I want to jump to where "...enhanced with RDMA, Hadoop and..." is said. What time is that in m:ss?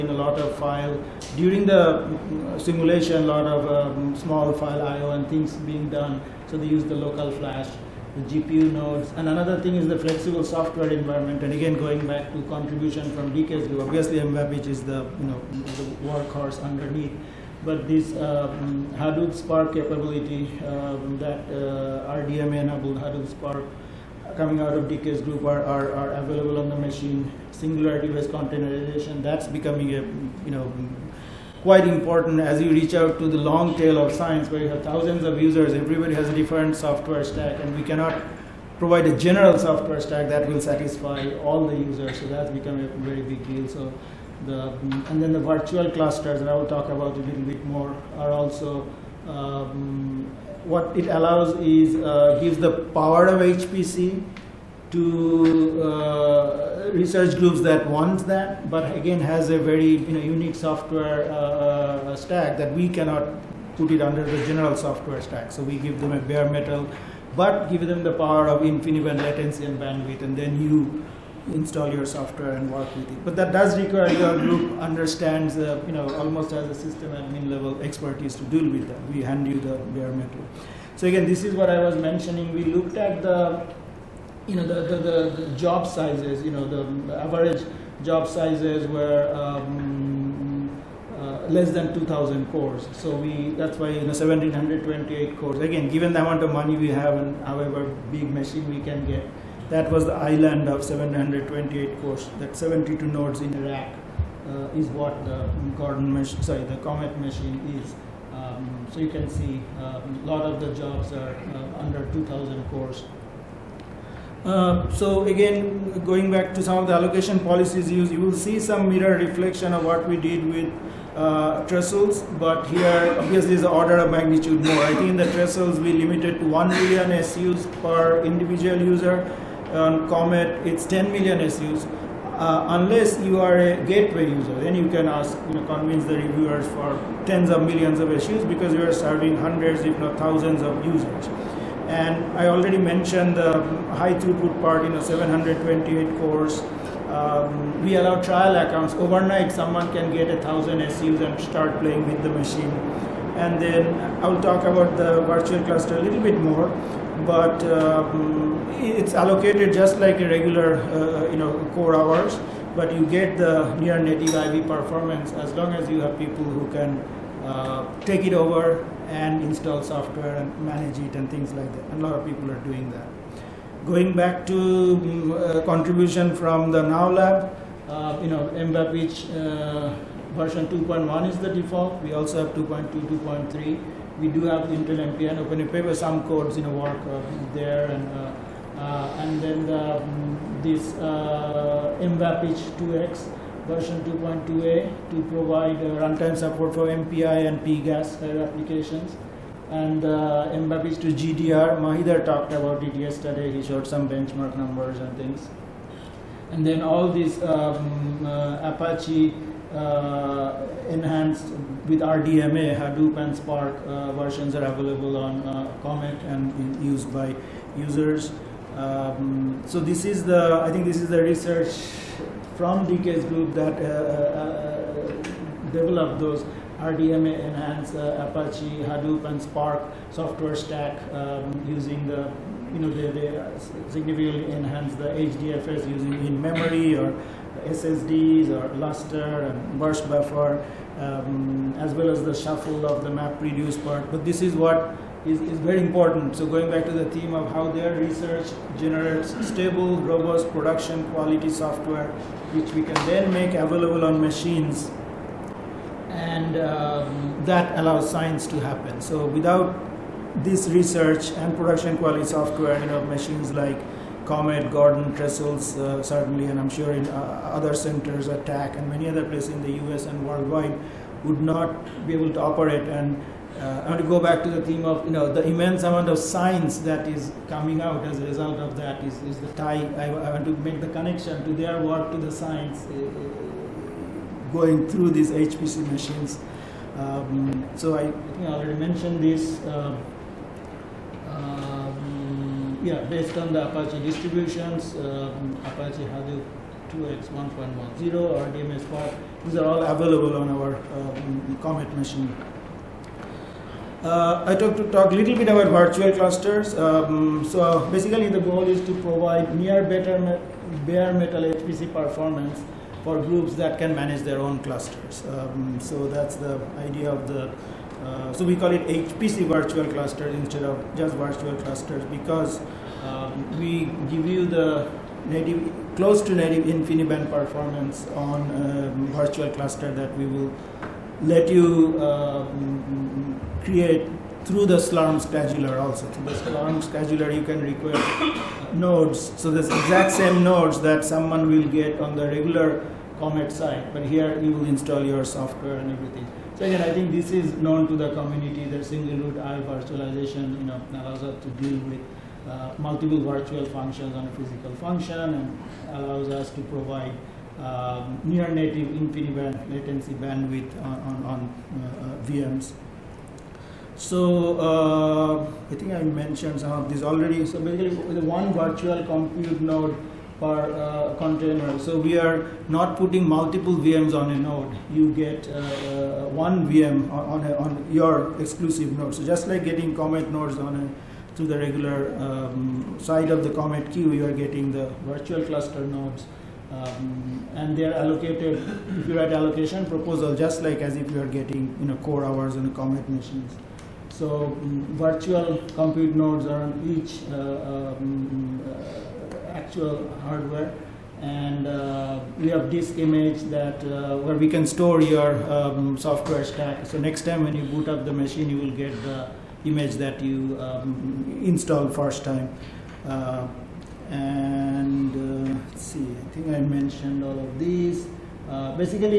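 3:30.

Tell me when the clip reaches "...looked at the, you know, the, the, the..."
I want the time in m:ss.
1:22.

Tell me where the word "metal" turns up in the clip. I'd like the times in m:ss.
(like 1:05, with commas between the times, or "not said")
1:06, 1:20, 5:11.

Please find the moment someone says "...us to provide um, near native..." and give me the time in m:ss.
5:56.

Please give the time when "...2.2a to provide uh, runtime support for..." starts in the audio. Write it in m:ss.
3:14.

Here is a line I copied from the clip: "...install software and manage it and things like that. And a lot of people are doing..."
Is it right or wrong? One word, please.
right.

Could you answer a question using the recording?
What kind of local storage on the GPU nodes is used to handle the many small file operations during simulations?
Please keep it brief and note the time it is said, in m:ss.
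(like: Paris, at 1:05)
local flash, at 0:06.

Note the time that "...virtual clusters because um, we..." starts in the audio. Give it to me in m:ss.
5:21.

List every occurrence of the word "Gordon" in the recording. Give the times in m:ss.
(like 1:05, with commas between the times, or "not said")
1:45, 4:24.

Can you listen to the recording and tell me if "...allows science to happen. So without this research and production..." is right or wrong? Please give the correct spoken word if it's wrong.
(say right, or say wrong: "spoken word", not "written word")
right.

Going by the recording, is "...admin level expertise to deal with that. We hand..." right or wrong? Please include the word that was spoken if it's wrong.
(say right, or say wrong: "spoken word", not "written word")
right.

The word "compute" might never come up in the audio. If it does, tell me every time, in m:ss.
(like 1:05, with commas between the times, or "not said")
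6:09, 6:35.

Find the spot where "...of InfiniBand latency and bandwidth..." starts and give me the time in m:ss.
1:08.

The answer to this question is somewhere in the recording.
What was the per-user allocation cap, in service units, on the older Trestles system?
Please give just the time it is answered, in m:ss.
2:06.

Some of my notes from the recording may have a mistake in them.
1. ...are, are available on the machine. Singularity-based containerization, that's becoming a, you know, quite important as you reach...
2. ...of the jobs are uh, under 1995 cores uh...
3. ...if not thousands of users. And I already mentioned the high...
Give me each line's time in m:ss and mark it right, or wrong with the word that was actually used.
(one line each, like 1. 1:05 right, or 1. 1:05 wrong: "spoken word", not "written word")
1. 0:25 right
2. 1:50 wrong: "2000", not "1995"
3. 2:19 right.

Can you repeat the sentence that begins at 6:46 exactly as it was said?
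So next time when you boot up the machine, you will get the image that you um, installed first time.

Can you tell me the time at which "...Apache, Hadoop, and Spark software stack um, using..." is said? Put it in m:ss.
3:48.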